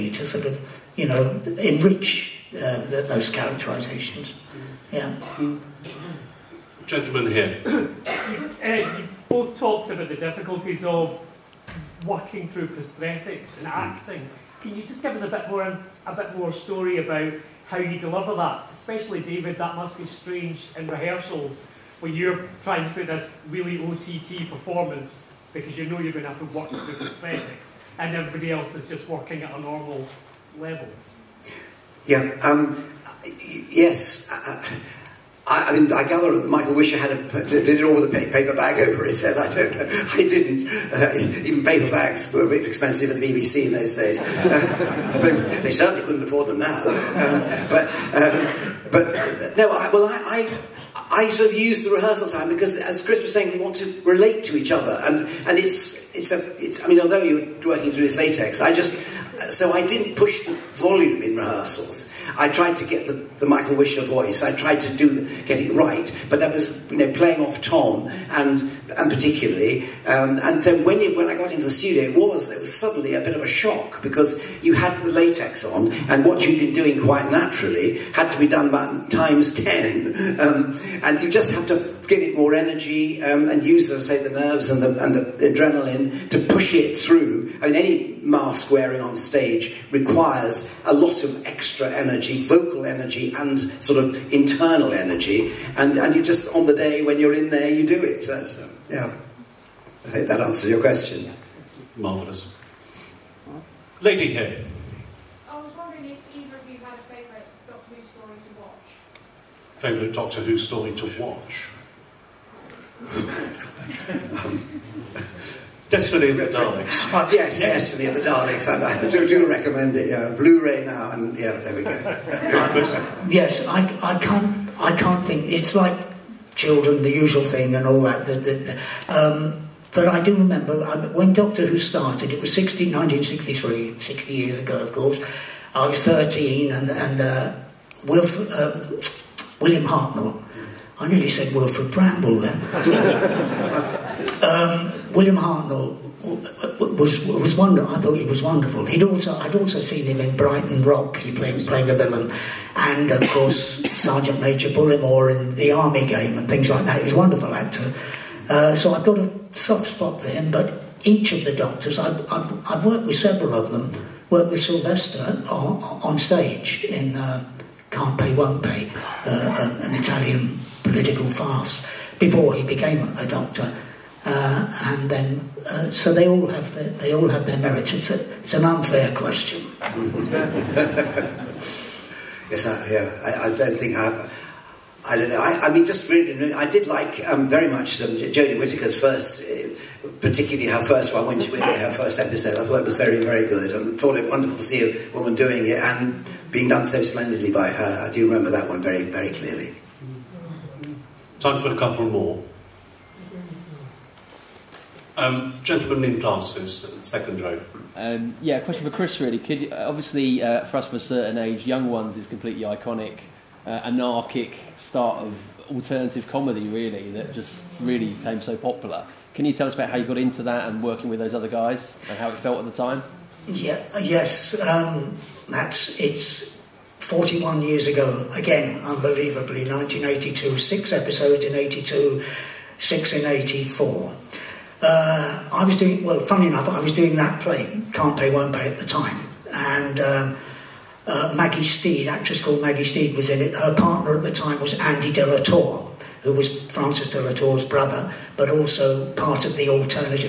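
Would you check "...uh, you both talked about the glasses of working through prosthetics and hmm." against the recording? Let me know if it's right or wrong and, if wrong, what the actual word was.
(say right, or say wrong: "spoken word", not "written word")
wrong: "difficulties", not "glasses".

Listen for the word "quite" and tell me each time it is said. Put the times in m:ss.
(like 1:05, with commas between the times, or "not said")
1:17.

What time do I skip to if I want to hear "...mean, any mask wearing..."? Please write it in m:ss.
1:27.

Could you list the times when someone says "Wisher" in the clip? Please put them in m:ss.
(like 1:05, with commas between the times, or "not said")
0:36, 1:03.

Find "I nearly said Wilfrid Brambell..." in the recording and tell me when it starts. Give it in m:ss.
2:20.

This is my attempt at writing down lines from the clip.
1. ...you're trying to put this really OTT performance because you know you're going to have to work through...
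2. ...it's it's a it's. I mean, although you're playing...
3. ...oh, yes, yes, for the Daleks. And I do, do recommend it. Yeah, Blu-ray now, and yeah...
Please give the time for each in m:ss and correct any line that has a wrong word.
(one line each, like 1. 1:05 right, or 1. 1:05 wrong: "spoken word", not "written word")
1. 0:22 right
2. 0:55 wrong: "working", not "playing"
3. 1:57 right.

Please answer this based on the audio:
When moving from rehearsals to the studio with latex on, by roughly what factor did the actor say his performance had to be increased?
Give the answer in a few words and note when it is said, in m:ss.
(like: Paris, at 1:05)
times ten, at 1:19.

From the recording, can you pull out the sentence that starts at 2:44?
Worked with Sylvester on, on stage in uh, Can't Pay Won't Pay, uh, an Italian political farce before he became a doctor.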